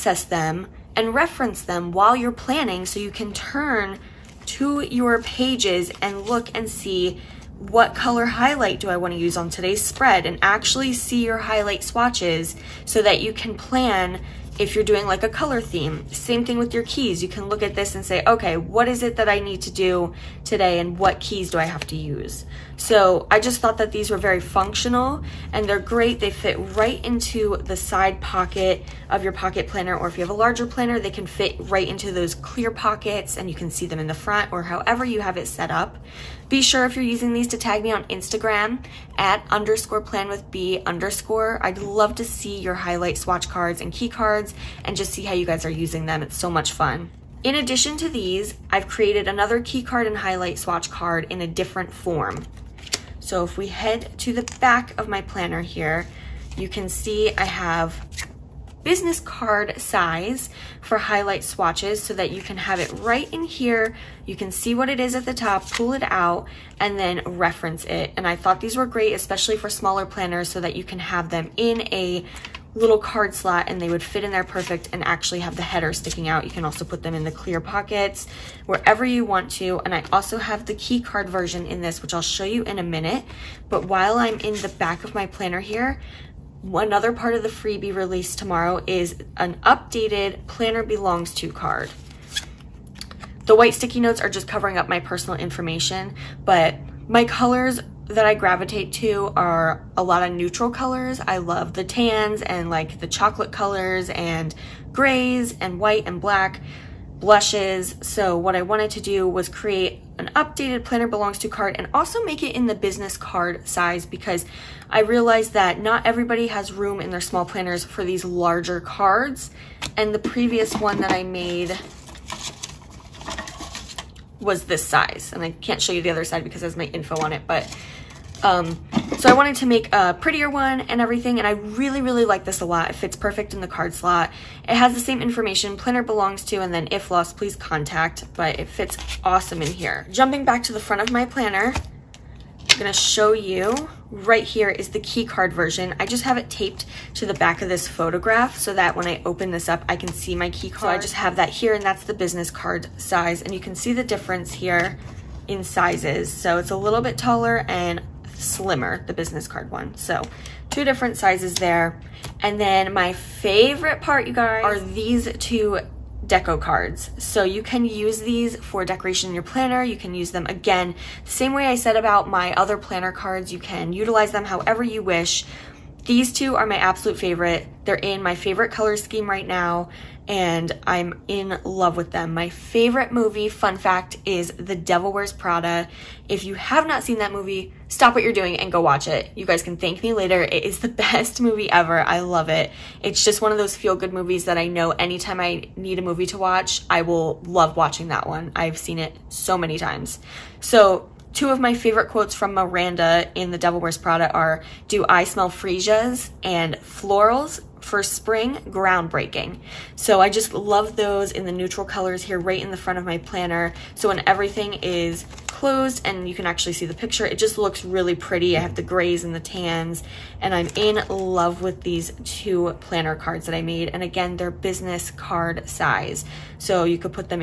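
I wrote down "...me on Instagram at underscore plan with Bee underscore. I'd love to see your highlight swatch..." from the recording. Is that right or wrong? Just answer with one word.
right.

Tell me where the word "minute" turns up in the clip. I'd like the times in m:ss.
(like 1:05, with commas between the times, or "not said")
1:22.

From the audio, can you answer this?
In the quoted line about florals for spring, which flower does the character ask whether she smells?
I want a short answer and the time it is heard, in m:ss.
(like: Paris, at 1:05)
Freesias, at 3:25.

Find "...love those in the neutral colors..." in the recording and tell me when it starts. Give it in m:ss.
3:30.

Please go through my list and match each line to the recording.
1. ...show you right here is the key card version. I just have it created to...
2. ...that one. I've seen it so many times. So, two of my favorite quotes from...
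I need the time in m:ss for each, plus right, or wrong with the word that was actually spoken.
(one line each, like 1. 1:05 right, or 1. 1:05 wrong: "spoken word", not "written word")
1. 2:22 wrong: "taped", not "created"
2. 3:18 right.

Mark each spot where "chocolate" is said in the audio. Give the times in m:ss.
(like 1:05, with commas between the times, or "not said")
1:43.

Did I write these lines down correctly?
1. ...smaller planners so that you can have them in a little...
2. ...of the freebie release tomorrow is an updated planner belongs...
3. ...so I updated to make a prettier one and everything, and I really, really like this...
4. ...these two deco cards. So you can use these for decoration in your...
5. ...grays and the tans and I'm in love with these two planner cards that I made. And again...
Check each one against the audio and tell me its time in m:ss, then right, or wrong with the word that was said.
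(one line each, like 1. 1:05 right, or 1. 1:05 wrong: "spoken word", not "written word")
1. 1:09 right
2. 1:27 right
3. 2:09 wrong: "wanted", not "updated"
4. 2:44 right
5. 3:38 right.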